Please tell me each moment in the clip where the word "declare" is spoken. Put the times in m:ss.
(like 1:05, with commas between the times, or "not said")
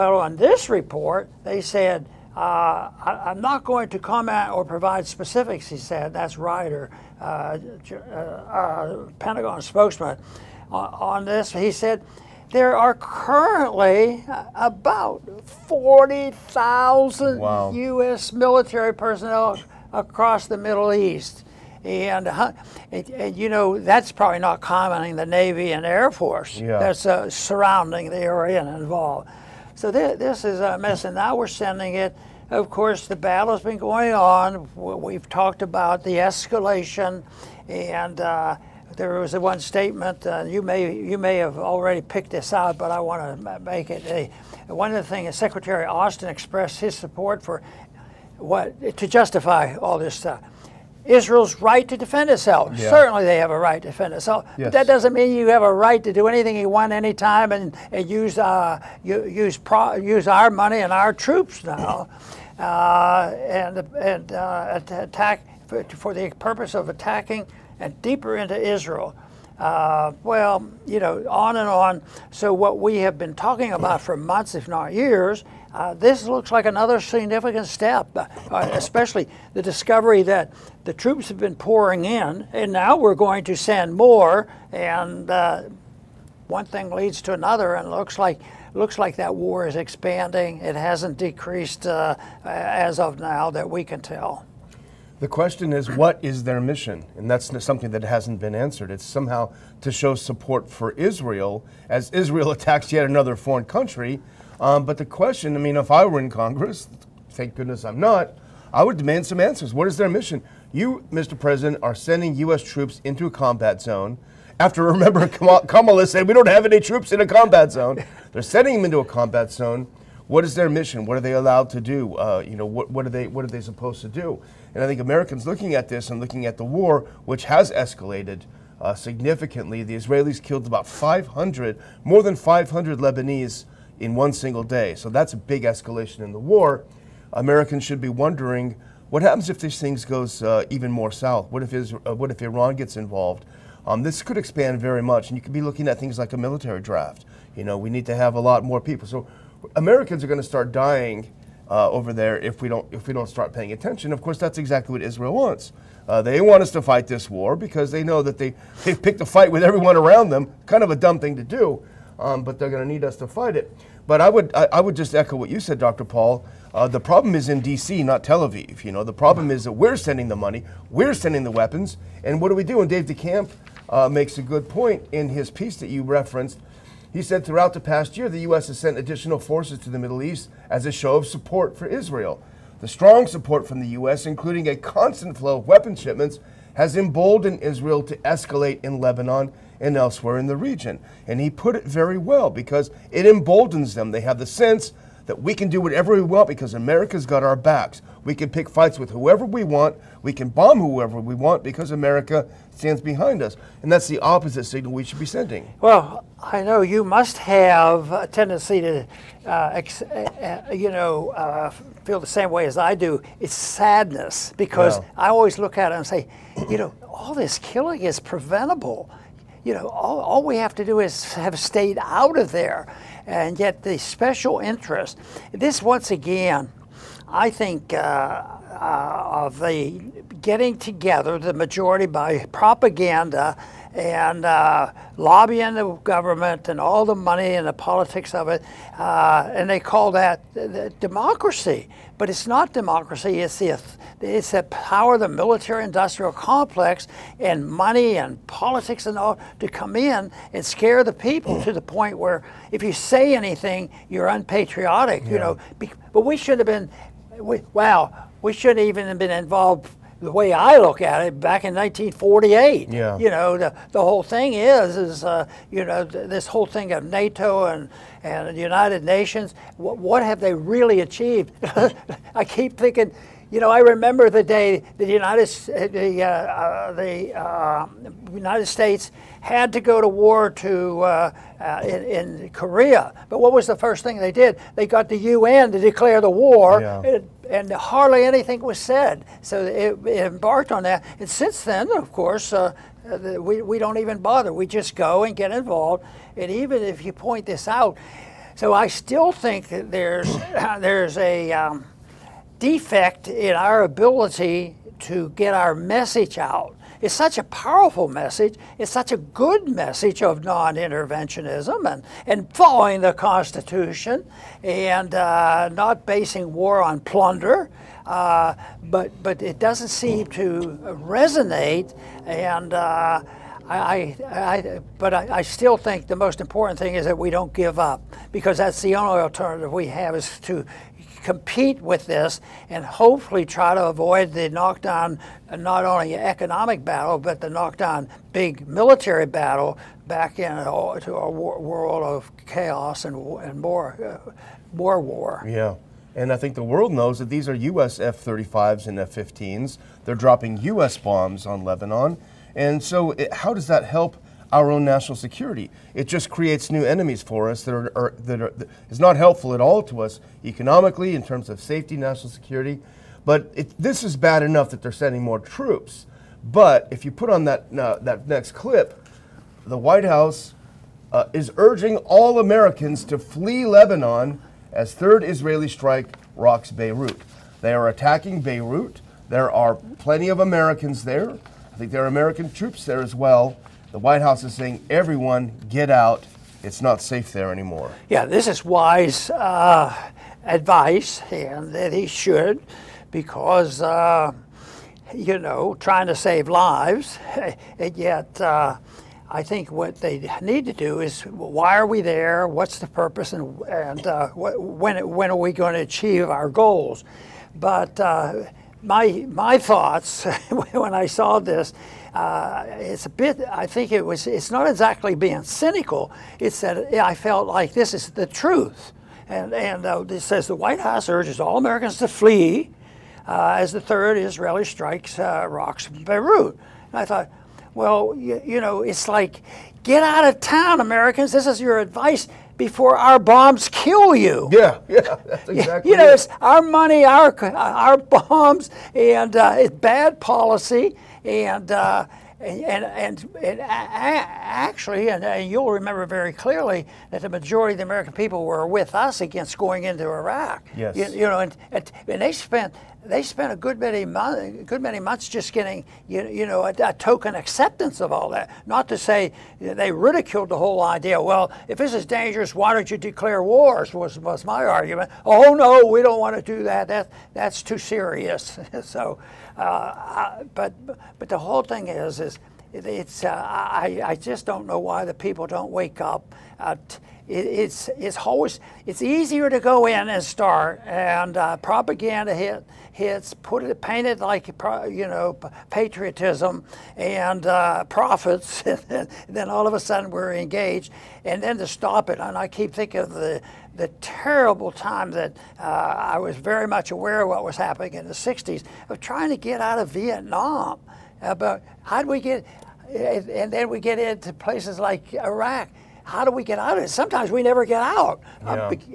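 4:45, 7:42.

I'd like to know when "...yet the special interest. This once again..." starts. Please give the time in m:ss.
3:43.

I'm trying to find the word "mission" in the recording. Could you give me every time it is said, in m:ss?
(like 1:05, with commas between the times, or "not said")
1:36, 1:50, 2:00.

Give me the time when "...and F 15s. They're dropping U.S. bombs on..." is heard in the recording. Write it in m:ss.
5:48.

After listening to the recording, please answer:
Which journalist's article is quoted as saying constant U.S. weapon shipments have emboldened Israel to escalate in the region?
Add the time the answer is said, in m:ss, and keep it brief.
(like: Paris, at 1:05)
Dave DeCamp, at 2:52.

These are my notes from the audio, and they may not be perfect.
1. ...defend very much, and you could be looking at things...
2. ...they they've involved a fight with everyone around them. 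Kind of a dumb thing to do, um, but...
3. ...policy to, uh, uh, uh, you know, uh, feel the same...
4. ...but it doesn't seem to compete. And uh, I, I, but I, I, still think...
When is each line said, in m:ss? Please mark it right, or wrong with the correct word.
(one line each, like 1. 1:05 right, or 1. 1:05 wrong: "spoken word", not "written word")
1. 2:24 wrong: "expand", not "defend"
2. 2:38 wrong: "picked", not "involved"
3. 3:28 wrong: "tendency", not "policy"
4. 5:19 wrong: "resonate", not "compete".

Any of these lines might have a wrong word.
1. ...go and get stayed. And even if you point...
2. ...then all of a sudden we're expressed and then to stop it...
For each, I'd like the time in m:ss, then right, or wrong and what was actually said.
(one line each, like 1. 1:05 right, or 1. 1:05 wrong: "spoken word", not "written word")
1. 4:54 wrong: "involved", not "stayed"
2. 8:09 wrong: "engaged", not "expressed".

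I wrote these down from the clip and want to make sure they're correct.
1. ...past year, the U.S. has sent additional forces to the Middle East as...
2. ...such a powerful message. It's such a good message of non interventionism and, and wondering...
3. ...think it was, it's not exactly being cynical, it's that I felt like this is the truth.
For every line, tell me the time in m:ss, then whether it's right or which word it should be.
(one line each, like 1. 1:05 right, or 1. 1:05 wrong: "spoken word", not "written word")
1. 2:57 right
2. 5:07 wrong: "following", not "wondering"
3. 6:53 right.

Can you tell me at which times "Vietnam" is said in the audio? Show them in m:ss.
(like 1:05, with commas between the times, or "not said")
8:19.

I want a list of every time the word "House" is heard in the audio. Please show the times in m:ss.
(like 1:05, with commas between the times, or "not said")
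6:10, 6:24, 7:00.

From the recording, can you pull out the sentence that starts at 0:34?
We've talked about the escalation and.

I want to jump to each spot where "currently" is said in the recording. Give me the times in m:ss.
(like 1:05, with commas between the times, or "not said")
0:12.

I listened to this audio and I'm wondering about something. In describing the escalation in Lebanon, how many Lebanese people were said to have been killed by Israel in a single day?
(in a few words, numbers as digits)
more than 500.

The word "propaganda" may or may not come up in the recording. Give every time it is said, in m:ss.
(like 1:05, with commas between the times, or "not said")
3:52, 8:01.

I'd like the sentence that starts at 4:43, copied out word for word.
But what was the first thing they did?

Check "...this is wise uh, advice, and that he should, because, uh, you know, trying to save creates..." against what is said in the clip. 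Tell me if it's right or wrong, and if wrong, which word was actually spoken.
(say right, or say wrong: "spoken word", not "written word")
wrong: "lives", not "creates".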